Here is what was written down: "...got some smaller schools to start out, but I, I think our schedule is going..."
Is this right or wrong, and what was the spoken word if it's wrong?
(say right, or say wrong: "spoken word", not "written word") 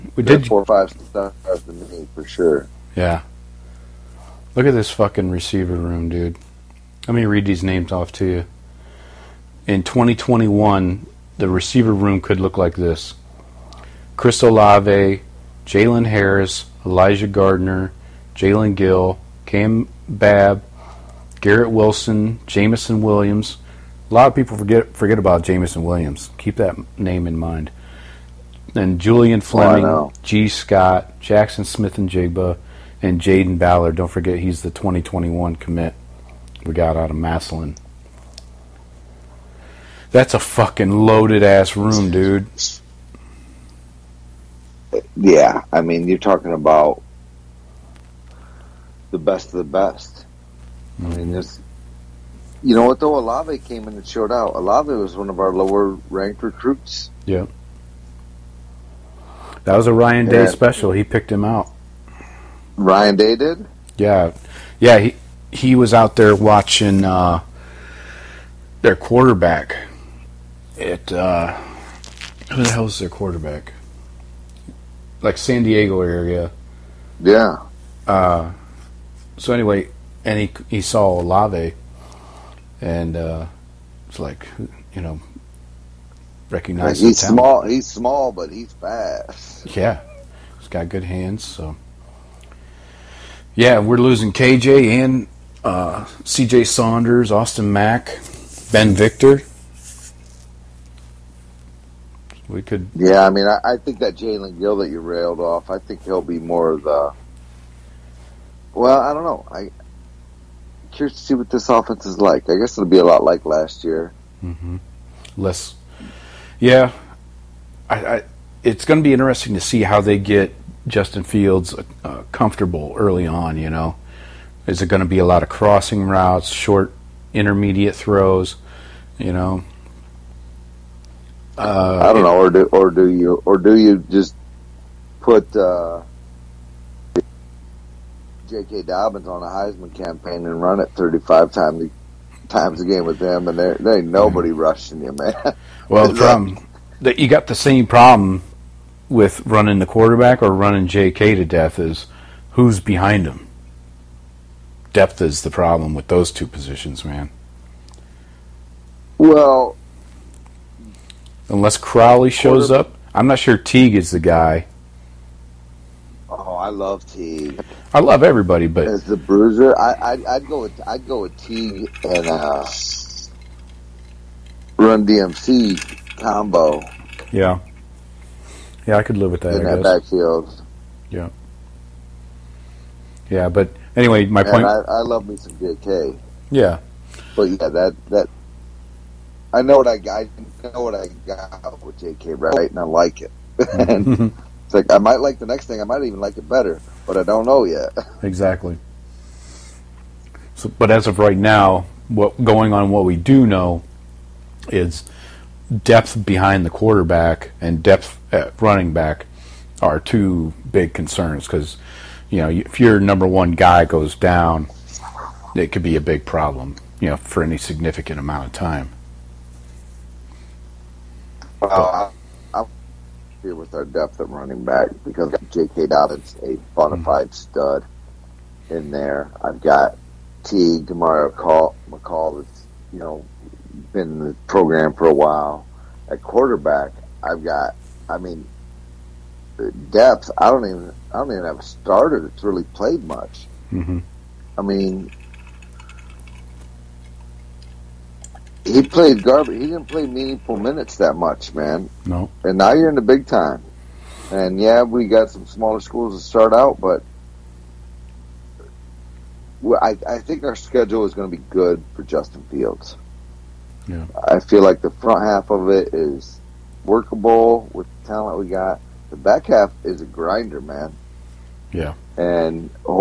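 right.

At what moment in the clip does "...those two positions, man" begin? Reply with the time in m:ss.
2:36.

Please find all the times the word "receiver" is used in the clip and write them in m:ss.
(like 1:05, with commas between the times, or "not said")
0:05, 0:11.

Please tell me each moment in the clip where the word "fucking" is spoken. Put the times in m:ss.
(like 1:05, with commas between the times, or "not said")
0:04, 0:40.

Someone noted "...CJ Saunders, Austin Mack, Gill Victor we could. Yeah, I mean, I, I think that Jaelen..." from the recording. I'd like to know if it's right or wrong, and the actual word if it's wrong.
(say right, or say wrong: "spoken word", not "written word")
wrong: "Ben", not "Gill".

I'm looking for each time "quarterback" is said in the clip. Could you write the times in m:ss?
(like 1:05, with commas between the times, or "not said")
1:08, 1:13, 2:29, 3:26, 3:56.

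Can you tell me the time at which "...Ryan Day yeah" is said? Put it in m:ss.
0:59.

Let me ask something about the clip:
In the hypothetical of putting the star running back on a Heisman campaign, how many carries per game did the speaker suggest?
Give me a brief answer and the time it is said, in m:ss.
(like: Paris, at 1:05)
35, at 2:20.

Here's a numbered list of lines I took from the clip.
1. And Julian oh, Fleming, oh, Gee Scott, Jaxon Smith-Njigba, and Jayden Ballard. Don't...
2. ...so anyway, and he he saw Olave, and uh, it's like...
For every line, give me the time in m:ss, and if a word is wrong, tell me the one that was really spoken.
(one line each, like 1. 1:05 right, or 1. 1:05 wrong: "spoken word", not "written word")
1. 0:28 right
2. 1:19 right.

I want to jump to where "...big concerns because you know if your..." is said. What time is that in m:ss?
3:30.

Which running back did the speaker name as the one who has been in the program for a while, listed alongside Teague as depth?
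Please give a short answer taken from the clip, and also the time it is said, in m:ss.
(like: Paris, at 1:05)
Demario McCall, at 3:50.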